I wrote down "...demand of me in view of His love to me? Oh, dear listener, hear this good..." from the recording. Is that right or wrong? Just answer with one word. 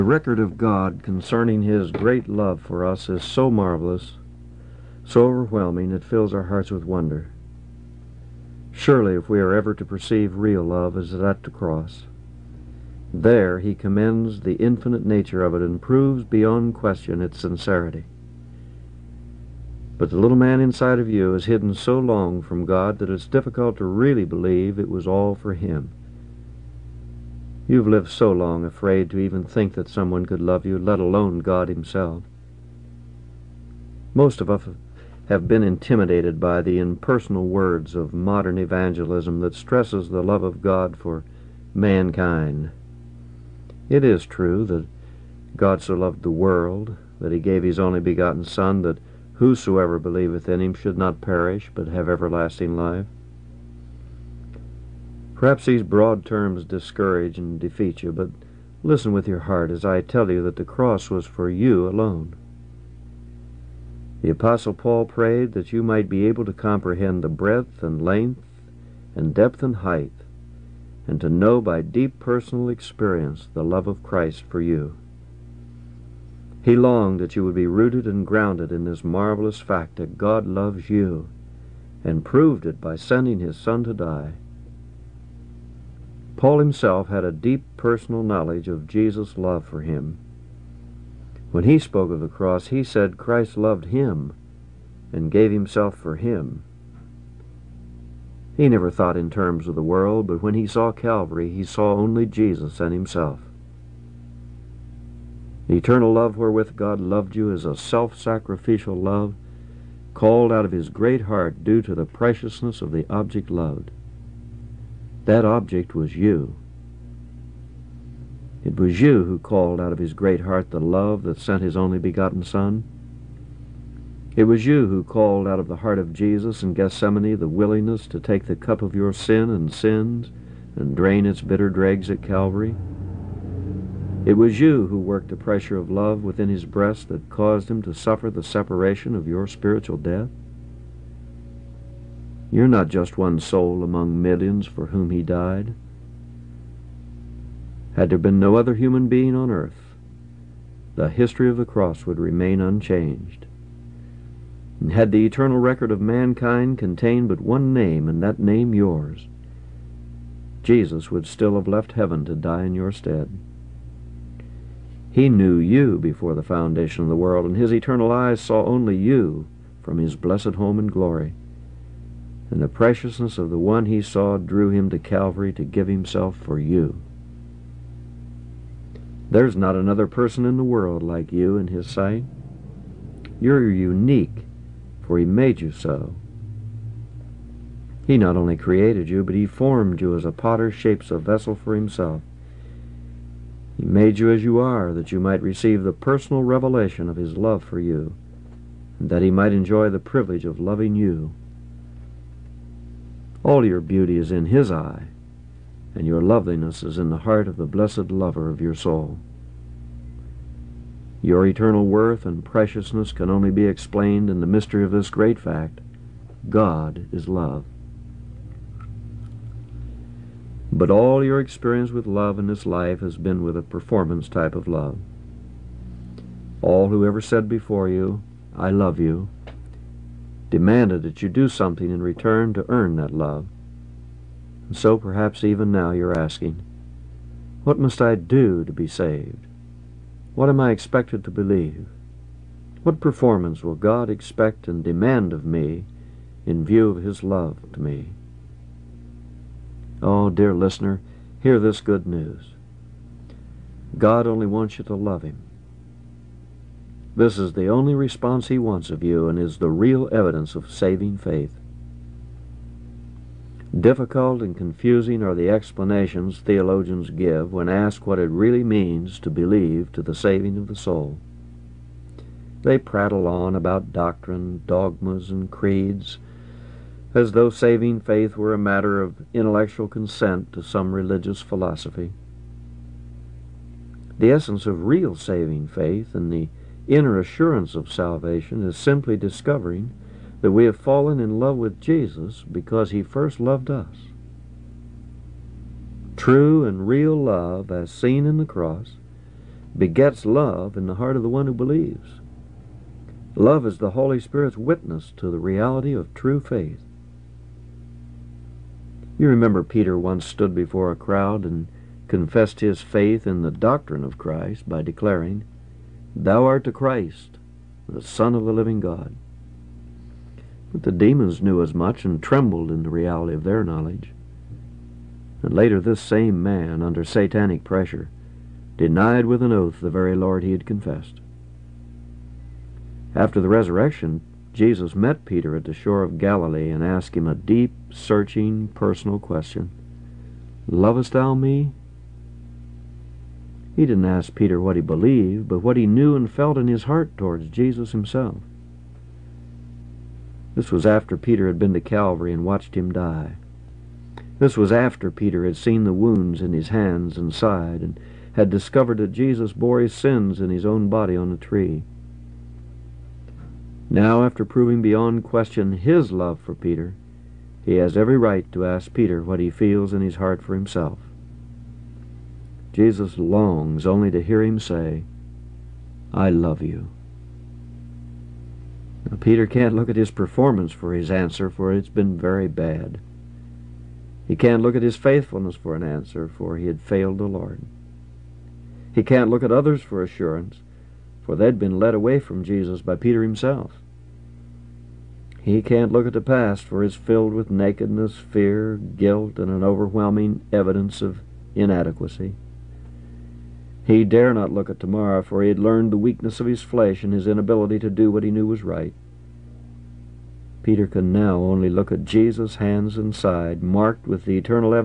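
right.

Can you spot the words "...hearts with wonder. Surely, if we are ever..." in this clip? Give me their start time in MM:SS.
00:06.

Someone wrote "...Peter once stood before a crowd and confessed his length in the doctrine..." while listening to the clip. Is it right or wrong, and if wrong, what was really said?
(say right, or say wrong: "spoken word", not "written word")
wrong: "faith", not "length".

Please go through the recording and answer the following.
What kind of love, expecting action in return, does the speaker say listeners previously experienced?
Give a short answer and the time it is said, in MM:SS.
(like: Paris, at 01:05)
Performance type of love, at 03:43.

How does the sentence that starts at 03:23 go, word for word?
All your beauty is in his eye, and your loveliness is in the heart of the blessed lover of your soul.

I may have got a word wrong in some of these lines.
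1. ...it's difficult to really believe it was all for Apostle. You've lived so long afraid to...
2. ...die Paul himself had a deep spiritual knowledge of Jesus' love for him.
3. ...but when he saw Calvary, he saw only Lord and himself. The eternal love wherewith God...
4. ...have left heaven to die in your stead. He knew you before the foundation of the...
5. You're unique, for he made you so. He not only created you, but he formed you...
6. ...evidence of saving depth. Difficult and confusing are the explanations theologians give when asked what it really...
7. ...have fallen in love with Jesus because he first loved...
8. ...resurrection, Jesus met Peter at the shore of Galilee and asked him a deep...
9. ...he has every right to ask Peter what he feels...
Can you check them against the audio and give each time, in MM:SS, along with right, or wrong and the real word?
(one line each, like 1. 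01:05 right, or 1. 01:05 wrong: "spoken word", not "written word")
1. 00:23 wrong: "Him", not "Apostle"
2. 01:23 wrong: "personal", not "spiritual"
3. 01:40 wrong: "Jesus", not "Lord"
4. 02:41 right
5. 03:03 right
6. 04:20 wrong: "faith", not "depth"
7. 04:50 right
8. 05:33 right
9. 06:07 right.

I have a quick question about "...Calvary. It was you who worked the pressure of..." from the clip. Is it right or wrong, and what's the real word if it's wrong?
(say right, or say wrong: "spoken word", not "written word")
right.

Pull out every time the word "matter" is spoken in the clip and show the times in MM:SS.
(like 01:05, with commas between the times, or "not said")
04:38.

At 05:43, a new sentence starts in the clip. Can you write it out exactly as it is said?
He didn't ask Peter what he believed, but what he knew and felt in his heart towards Jesus himself.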